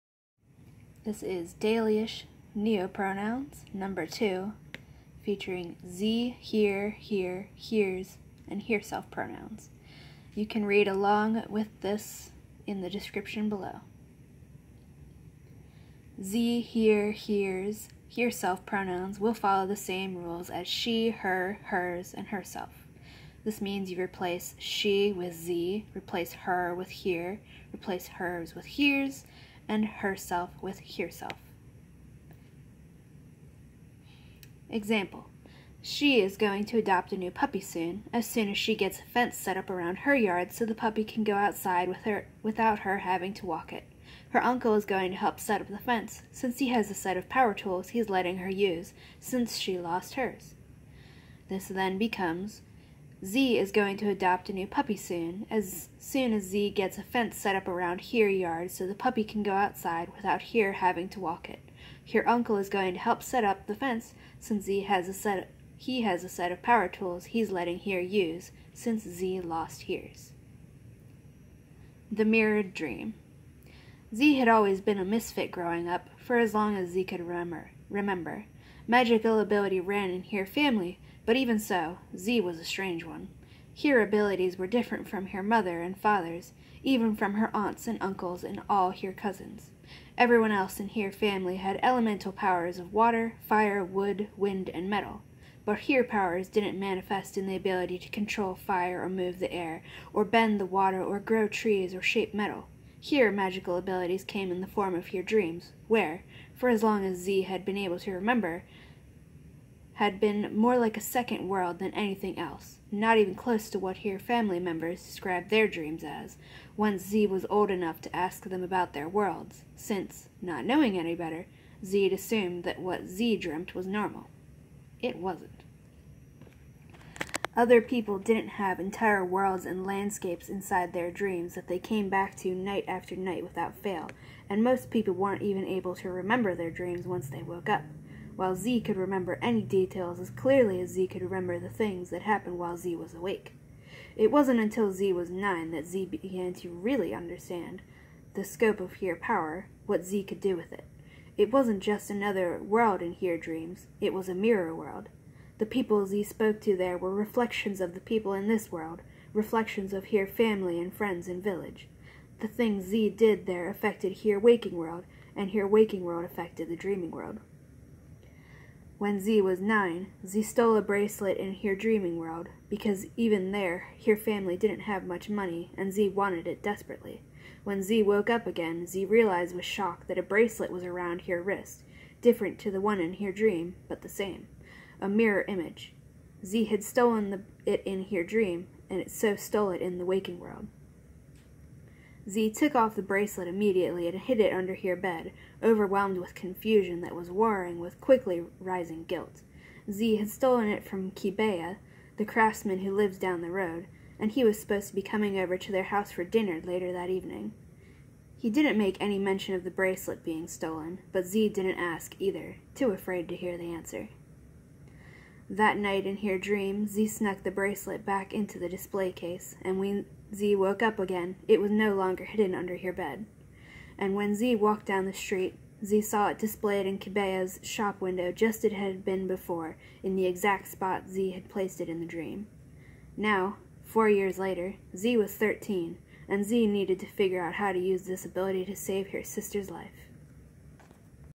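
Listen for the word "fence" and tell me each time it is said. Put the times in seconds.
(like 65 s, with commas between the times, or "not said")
39 s, 45 s, 57 s, 63 s.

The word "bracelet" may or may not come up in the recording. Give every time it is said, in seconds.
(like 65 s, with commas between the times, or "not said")
170 s, 180 s, 193 s, 209 s, 217 s.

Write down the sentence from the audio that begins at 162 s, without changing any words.
The things ze did there affected hir waking world, and hir waking world affected the dreaming world.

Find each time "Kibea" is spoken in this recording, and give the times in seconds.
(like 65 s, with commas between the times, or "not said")
201 s, 226 s.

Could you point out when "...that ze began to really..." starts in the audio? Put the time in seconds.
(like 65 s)
145 s.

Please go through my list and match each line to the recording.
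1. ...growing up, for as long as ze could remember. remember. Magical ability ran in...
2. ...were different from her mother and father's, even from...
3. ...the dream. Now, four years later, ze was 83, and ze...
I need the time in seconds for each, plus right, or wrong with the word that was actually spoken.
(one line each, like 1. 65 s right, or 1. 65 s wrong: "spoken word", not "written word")
1. 75 s right
2. 84 s right
3. 231 s wrong: "13", not "83".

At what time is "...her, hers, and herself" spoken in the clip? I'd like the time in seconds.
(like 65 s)
21 s.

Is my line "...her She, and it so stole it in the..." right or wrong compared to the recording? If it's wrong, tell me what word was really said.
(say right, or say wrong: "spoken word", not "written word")
wrong: "Dream", not "She".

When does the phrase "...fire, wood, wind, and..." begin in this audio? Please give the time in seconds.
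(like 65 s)
93 s.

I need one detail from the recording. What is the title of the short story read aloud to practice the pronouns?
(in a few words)
The Mirrored Dream.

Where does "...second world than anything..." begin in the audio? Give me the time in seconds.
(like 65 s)
110 s.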